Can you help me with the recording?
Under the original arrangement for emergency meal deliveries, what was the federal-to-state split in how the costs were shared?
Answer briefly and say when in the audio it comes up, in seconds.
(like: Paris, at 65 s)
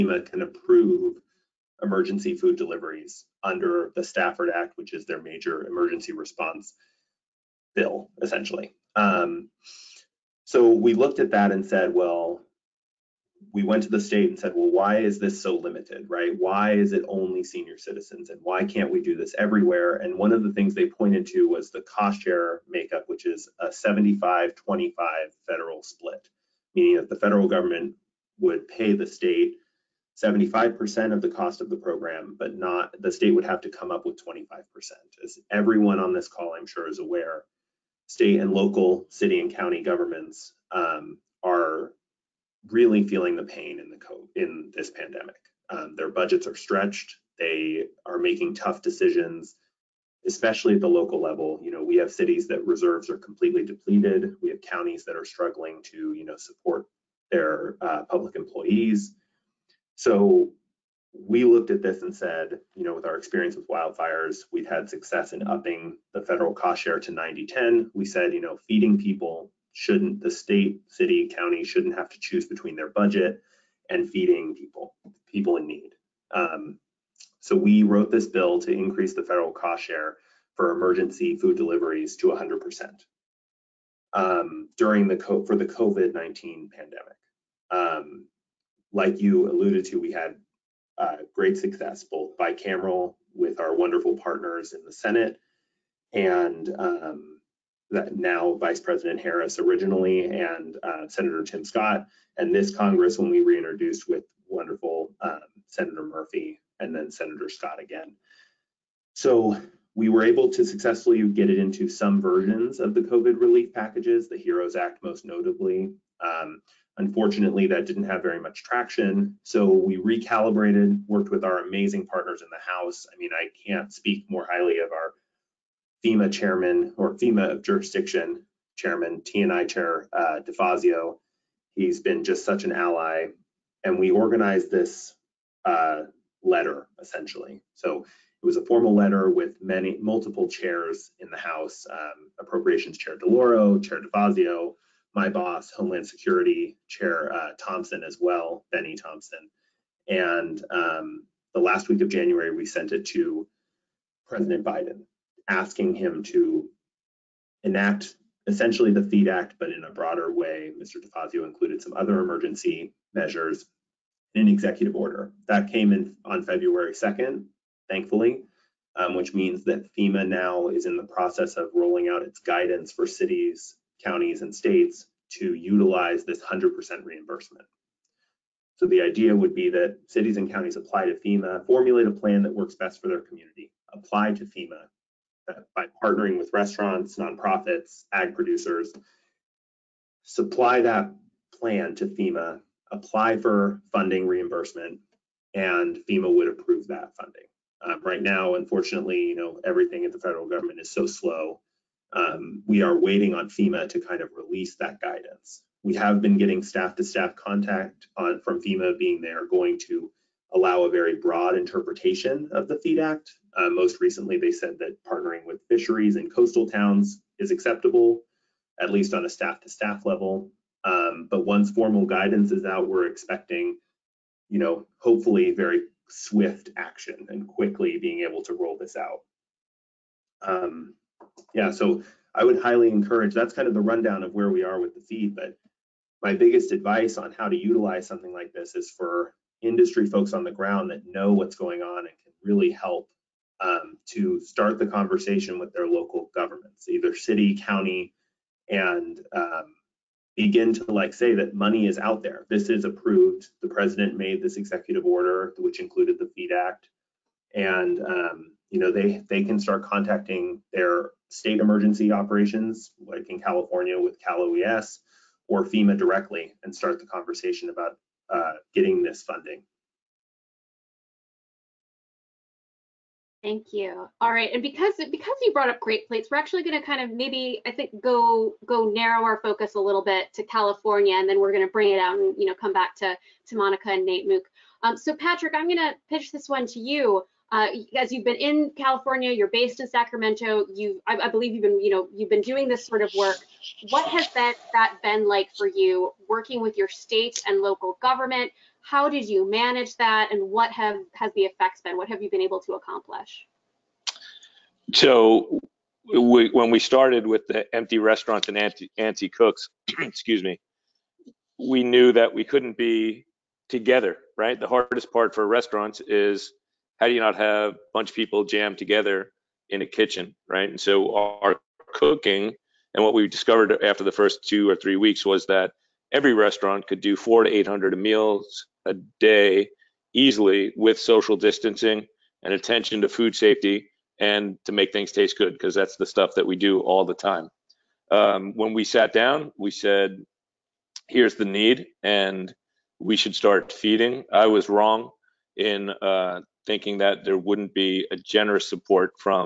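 75-25, at 23 s.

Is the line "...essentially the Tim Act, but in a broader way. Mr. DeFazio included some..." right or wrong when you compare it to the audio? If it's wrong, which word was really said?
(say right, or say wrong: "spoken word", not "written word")
wrong: "FEED", not "Tim".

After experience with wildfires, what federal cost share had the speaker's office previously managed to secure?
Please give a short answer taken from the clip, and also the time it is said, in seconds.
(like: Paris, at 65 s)
90-10, at 67 s.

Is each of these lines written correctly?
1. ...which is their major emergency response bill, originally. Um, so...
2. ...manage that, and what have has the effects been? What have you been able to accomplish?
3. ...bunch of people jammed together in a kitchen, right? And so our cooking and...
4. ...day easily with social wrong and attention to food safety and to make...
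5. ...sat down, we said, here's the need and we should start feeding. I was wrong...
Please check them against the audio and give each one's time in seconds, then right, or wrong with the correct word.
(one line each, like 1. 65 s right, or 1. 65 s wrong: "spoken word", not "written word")
1. 4 s wrong: "essentially", not "originally"
2. 299 s right
3. 317 s right
4. 329 s wrong: "distancing", not "wrong"
5. 338 s right.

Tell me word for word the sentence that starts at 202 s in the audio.
Um, we are waiting on FEMA to kind of release that guidance.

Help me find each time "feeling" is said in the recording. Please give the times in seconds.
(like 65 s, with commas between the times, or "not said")
43 s.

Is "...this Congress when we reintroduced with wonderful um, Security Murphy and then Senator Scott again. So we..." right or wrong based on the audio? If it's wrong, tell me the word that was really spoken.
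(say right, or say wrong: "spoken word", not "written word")
wrong: "Senator", not "Security".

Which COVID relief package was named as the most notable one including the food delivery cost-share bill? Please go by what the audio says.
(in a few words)
HEROES Act.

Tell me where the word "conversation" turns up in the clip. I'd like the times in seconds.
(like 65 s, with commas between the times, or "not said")
244 s, 267 s.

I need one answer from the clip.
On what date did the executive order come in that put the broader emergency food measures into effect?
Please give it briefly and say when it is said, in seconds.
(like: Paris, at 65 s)
February 2, at 166 s.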